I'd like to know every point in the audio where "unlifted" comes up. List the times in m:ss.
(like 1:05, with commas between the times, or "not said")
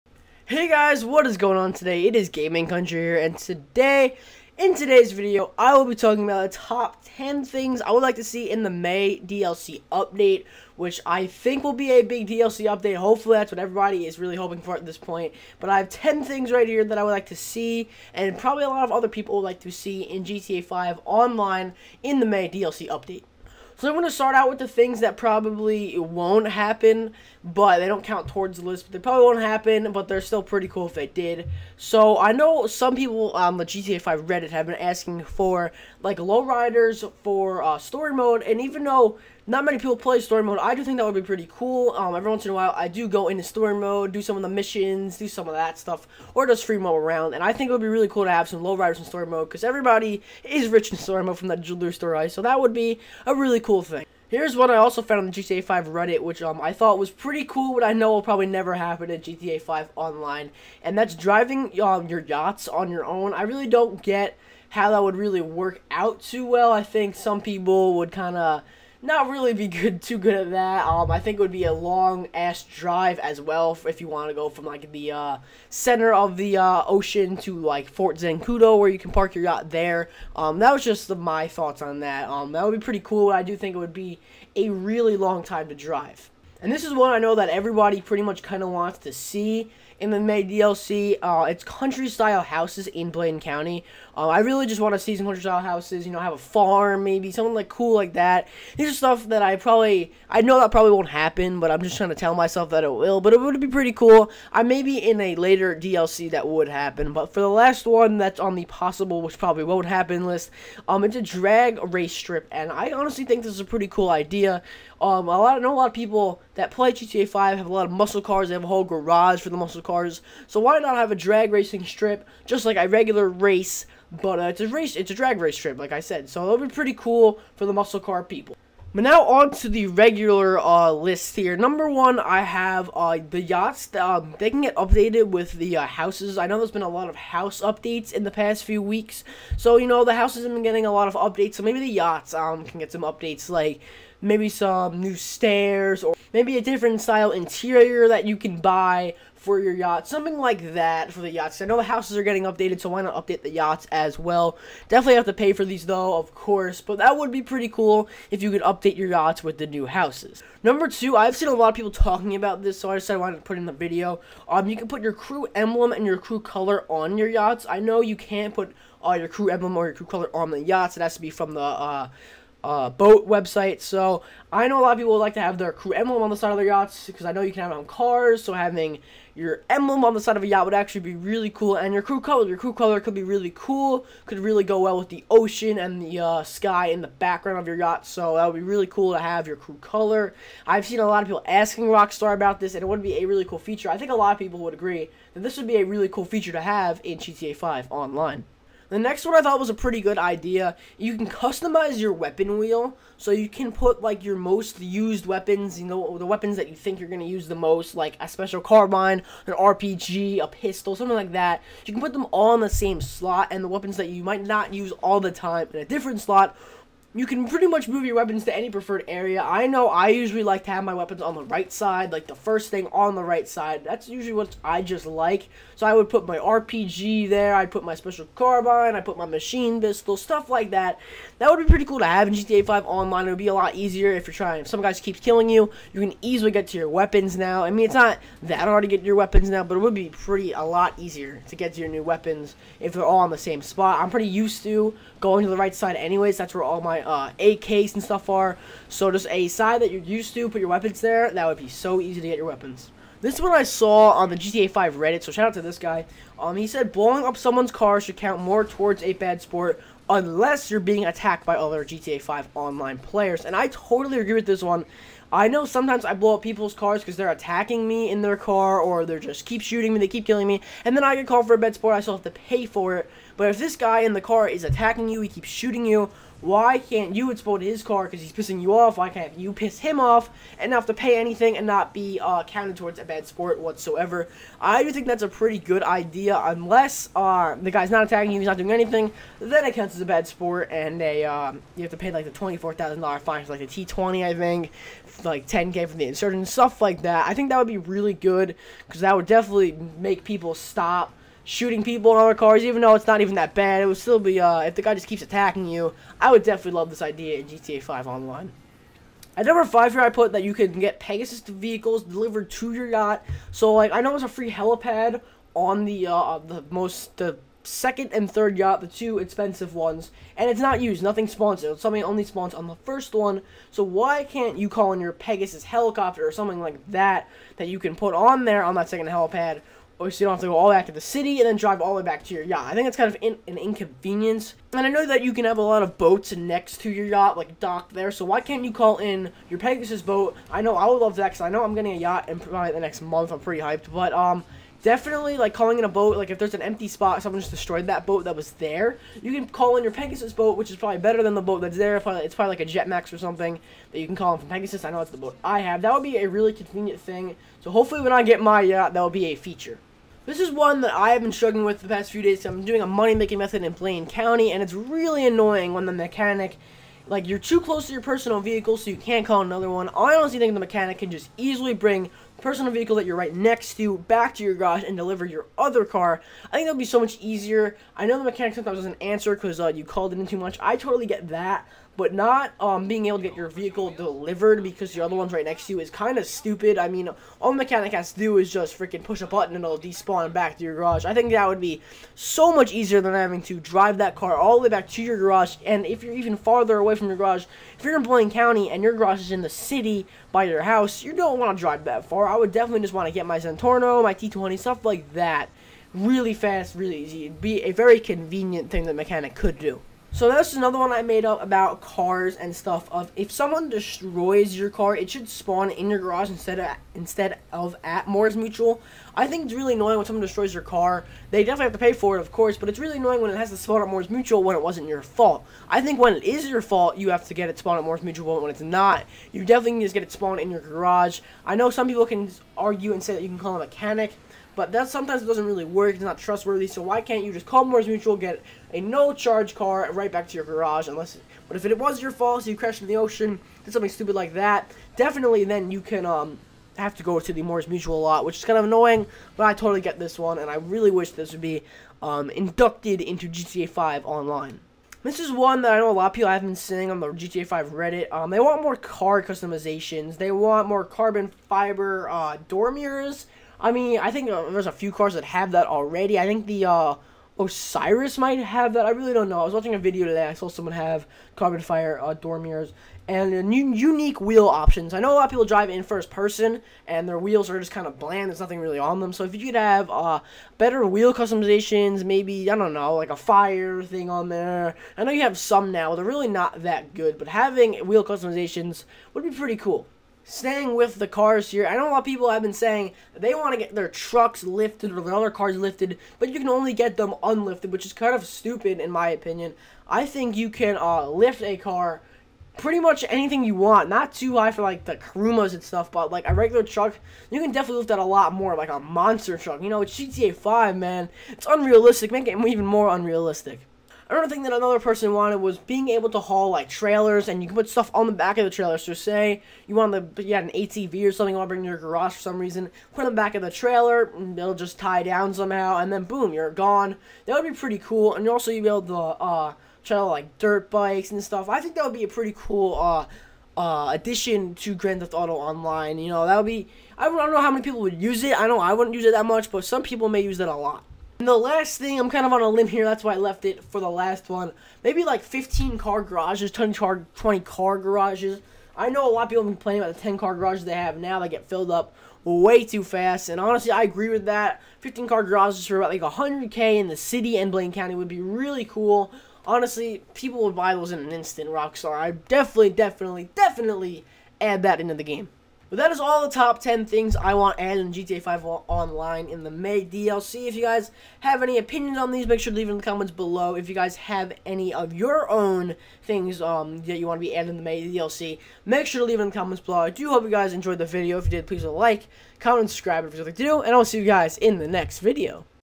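8:17.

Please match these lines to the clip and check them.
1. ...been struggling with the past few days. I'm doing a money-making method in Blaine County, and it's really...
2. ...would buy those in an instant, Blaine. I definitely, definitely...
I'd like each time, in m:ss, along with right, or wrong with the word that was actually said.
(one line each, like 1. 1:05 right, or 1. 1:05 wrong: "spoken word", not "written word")
1. 6:01 right
2. 9:20 wrong: "Rockstar", not "Blaine".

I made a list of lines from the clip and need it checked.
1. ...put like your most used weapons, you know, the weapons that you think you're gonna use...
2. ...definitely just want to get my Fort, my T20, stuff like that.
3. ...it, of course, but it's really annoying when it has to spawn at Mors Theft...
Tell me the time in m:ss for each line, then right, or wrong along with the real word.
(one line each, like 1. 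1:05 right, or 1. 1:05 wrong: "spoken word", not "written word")
1. 3:23 right
2. 6:42 wrong: "Zentorno", not "Fort"
3. 7:02 wrong: "Mutual", not "Theft".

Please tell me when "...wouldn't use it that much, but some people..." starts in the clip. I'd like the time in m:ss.
8:58.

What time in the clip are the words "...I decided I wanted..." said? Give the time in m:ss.
2:42.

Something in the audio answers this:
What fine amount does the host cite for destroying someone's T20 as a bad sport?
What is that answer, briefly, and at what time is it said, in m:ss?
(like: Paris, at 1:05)
$24,000, at 4:52.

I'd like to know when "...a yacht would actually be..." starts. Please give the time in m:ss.
3:00.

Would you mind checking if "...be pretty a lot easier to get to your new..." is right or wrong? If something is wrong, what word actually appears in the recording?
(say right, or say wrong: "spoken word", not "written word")
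right.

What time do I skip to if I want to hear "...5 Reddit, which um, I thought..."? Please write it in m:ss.
0:55.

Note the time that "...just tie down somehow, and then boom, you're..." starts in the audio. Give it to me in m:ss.
8:44.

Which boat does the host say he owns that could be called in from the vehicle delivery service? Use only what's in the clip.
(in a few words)
Jetmax.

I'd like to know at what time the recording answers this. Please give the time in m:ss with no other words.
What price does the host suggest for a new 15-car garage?
9:16.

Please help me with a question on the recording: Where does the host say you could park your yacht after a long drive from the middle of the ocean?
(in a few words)
Fort Zancudo.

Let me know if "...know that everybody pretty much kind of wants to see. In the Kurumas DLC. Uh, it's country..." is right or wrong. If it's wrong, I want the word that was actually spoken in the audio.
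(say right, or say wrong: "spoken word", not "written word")
wrong: "May", not "Kurumas".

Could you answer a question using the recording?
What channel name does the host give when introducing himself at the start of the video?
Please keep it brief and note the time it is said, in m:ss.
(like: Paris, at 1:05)
Gaming Country, at 0:02.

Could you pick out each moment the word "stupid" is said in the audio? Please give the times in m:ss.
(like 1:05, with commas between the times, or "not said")
6:26, 7:23, 8:18.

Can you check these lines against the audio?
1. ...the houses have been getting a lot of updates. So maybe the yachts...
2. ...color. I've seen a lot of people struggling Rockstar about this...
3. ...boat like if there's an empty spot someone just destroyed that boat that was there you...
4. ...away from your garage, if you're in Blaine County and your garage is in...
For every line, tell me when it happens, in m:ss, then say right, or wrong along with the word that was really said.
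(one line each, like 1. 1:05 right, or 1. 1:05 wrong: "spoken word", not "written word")
1. 2:20 right
2. 3:09 wrong: "asking", not "struggling"
3. 5:45 right
4. 6:36 right.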